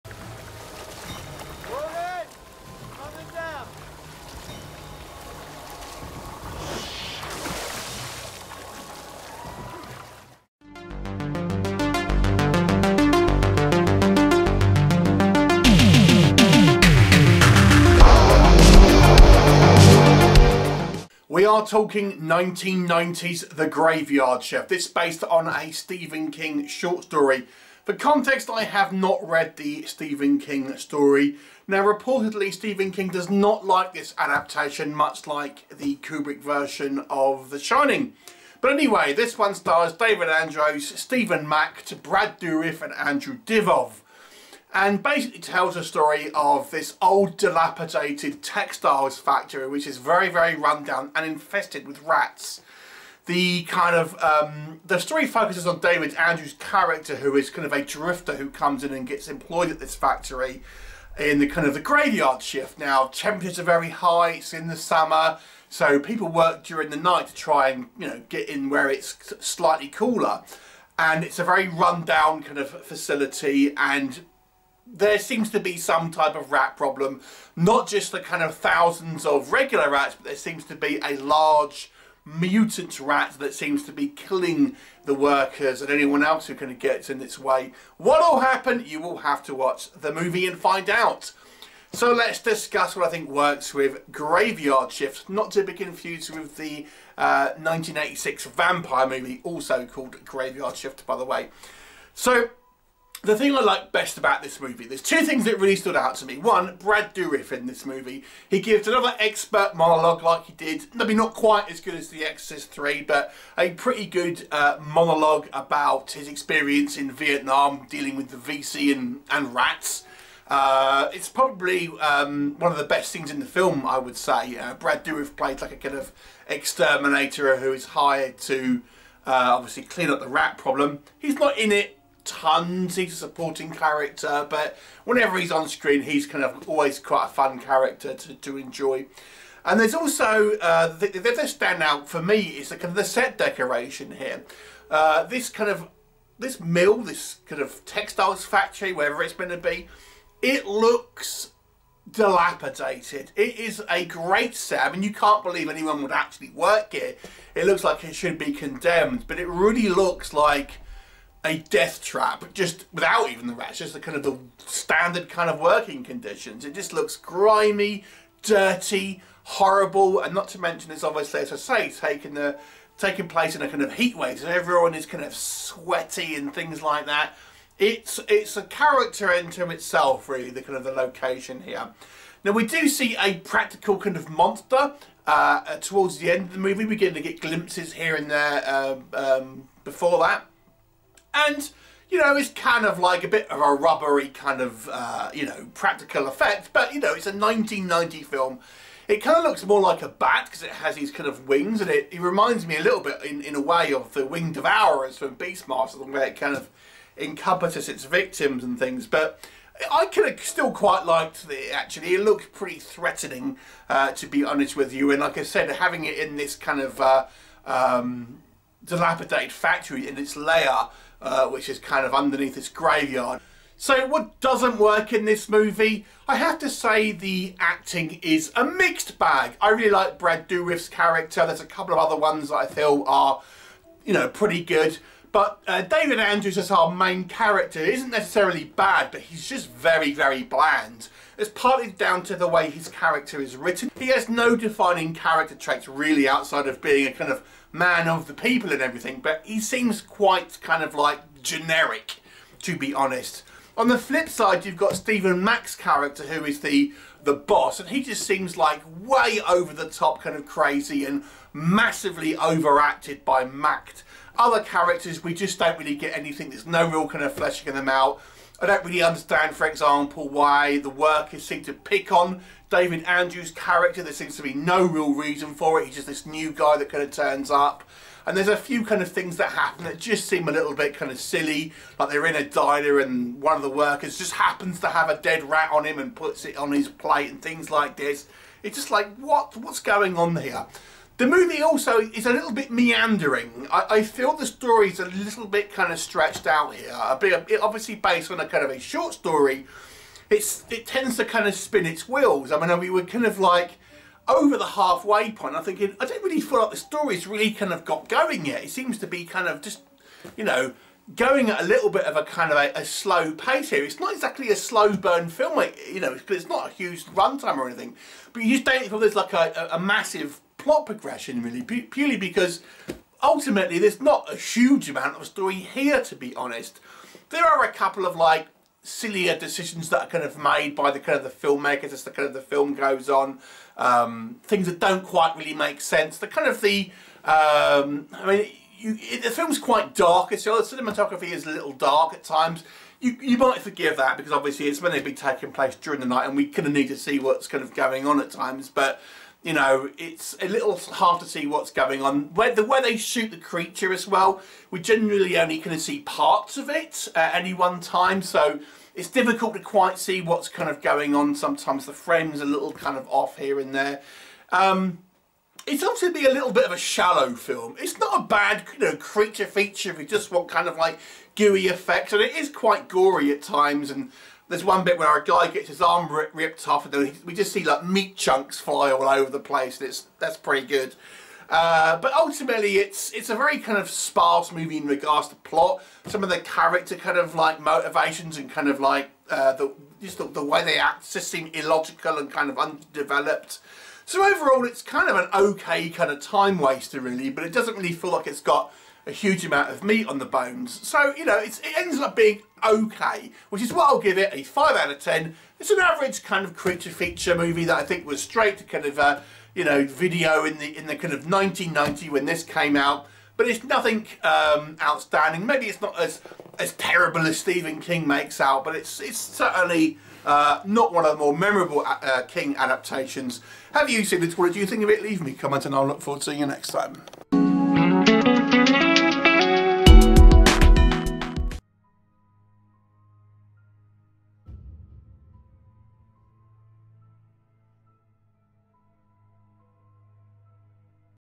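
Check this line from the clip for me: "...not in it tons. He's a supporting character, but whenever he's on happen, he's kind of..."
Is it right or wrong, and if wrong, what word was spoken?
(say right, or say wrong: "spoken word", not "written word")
wrong: "screen", not "happen".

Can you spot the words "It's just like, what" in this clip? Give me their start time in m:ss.
4:48.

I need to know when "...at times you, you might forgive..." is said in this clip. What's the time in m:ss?
5:42.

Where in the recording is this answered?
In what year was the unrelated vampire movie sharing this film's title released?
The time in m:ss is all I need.
1:37.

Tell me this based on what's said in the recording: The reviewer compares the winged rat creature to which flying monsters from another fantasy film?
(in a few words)
Winged Devourers.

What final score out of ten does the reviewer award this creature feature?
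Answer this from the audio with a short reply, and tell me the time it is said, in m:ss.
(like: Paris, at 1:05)
5, at 6:44.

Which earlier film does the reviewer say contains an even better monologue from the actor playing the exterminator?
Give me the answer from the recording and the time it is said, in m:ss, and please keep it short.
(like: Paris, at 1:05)
The Exorcist 3, at 1:52.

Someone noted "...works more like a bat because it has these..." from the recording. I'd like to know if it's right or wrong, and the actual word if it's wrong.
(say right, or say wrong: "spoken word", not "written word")
wrong: "looks", not "works".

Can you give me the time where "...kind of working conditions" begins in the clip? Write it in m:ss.
2:45.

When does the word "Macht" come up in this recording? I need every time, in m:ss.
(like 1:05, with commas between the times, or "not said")
0:41, 4:15, 4:23.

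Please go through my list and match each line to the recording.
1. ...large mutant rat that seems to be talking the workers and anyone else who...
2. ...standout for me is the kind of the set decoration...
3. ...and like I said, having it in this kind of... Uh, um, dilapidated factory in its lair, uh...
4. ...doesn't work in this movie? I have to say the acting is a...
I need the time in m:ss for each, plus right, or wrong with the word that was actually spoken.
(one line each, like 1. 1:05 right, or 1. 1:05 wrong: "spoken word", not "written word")
1. 1:21 wrong: "killing", not "talking"
2. 2:21 right
3. 3:35 right
4. 3:44 right.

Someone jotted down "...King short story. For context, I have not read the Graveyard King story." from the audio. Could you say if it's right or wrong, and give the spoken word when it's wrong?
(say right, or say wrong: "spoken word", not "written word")
wrong: "Stephen", not "Graveyard".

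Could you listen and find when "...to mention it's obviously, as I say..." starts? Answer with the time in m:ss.
2:50.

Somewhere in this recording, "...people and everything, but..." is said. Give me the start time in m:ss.
4:08.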